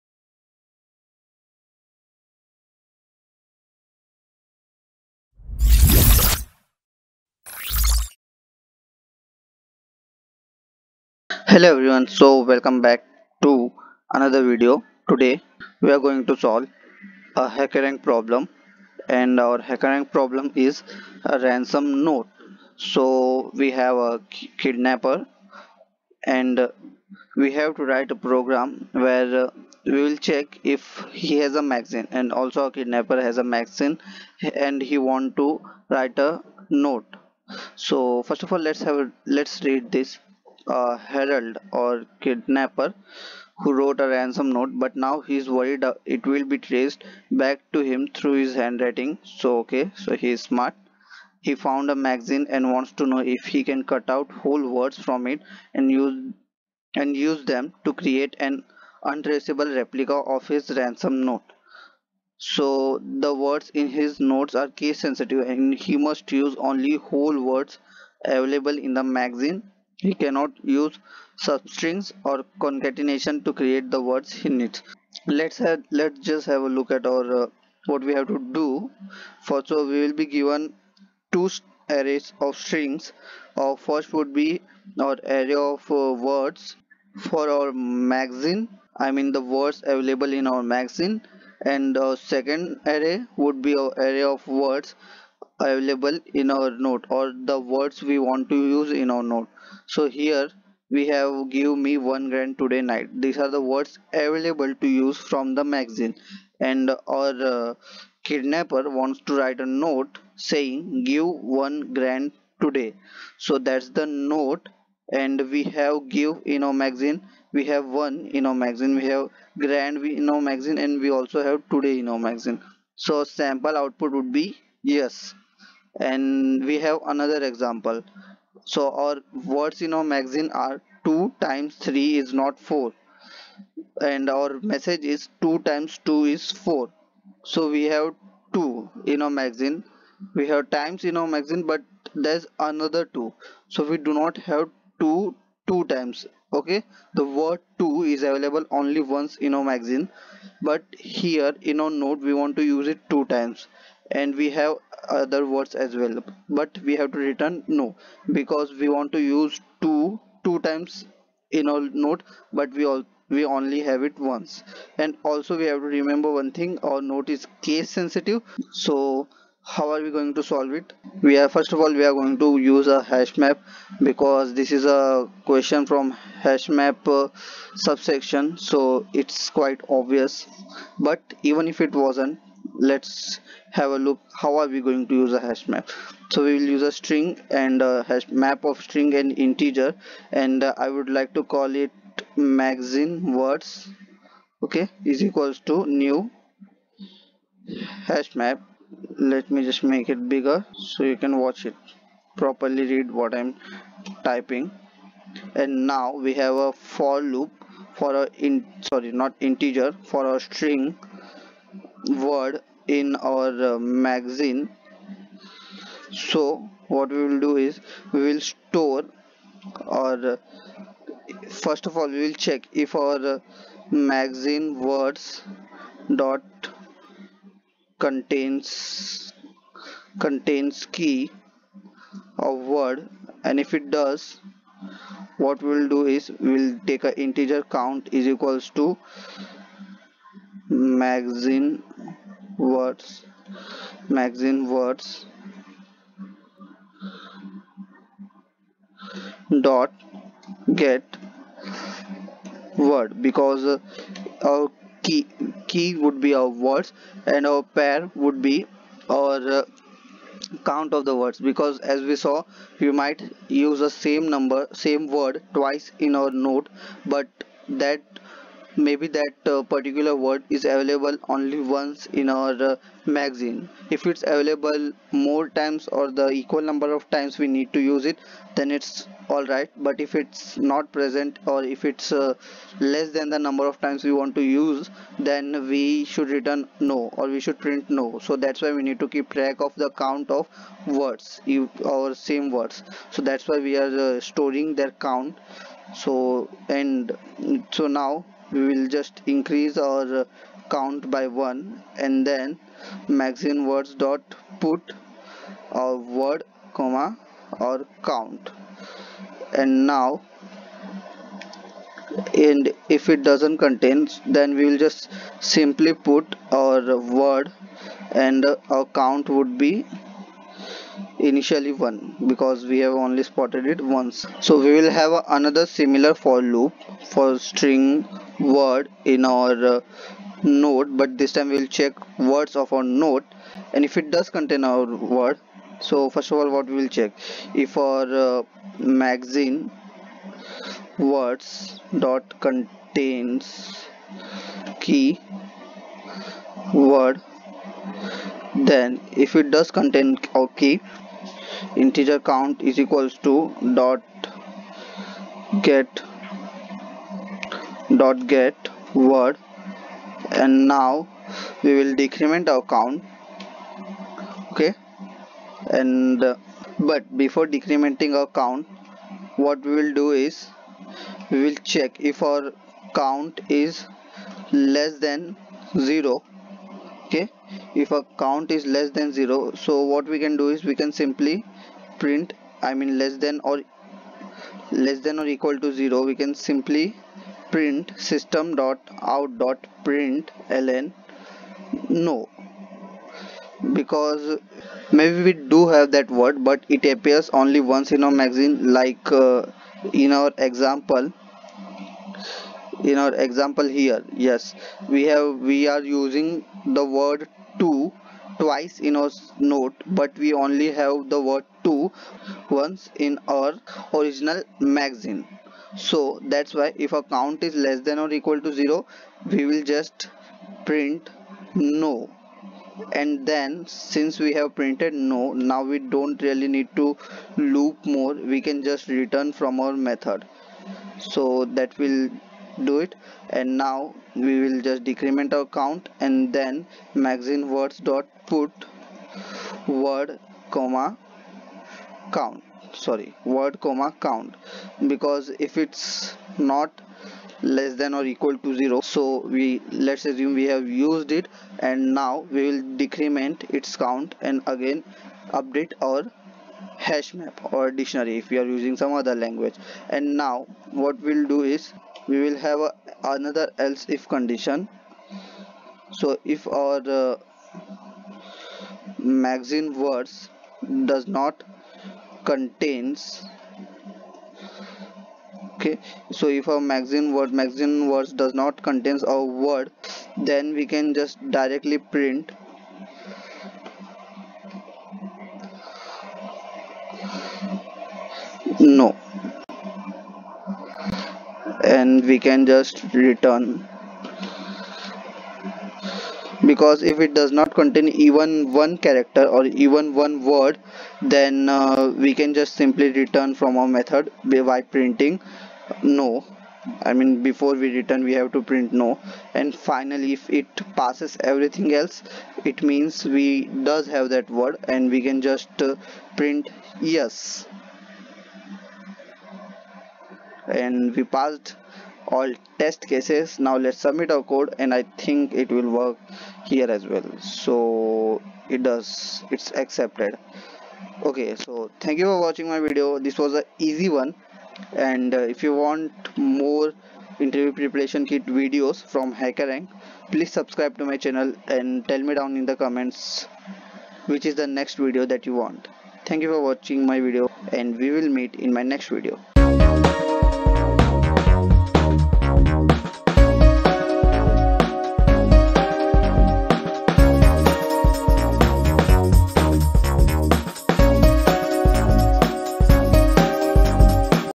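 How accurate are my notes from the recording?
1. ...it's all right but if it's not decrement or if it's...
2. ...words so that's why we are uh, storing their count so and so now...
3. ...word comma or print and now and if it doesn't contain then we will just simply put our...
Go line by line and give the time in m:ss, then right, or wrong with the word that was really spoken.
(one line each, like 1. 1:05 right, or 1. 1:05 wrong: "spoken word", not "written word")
1. 4:38 wrong: "present", not "decrement"
2. 4:52 right
3. 5:06 wrong: "count", not "print".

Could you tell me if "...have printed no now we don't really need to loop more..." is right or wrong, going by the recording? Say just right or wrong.
right.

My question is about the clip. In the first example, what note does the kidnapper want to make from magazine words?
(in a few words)
give one grand today.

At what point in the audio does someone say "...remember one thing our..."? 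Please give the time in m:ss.
2:45.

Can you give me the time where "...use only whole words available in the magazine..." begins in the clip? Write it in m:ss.
1:06.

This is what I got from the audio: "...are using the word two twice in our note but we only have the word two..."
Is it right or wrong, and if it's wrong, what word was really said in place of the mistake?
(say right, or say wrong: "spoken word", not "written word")
right.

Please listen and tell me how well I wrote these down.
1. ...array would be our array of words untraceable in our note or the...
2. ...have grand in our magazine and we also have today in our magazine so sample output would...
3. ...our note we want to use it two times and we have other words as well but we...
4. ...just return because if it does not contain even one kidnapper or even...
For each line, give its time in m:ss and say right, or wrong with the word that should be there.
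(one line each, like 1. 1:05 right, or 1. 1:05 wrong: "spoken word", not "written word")
1. 1:32 wrong: "available", not "untraceable"
2. 1:59 right
3. 2:31 right
4. 8:12 wrong: "character", not "kidnapper".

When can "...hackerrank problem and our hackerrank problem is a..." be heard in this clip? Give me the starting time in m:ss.
0:17.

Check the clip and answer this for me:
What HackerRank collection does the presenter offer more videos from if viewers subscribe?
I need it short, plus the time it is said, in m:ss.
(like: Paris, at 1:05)
interview preparation kit, at 8:57.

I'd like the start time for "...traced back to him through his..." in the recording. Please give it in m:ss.
0:46.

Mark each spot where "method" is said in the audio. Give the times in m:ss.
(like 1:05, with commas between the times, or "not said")
7:09, 8:23.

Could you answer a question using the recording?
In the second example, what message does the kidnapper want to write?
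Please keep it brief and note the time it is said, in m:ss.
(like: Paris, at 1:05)
2 times 2 is 4, at 2:15.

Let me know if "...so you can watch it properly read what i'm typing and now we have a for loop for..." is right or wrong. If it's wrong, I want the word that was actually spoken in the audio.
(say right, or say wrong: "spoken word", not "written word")
right.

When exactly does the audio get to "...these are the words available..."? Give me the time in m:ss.
1:43.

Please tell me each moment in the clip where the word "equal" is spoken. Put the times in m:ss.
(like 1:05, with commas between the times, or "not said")
3:15, 3:58, 4:36, 5:52, 6:25, 6:58, 7:28.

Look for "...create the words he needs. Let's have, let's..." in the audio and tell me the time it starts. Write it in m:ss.
1:13.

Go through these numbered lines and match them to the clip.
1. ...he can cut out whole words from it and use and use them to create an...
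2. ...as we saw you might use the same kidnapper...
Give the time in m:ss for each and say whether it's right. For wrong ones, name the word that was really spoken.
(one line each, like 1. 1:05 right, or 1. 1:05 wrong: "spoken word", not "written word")
1. 0:53 right
2. 4:21 wrong: "number", not "kidnapper".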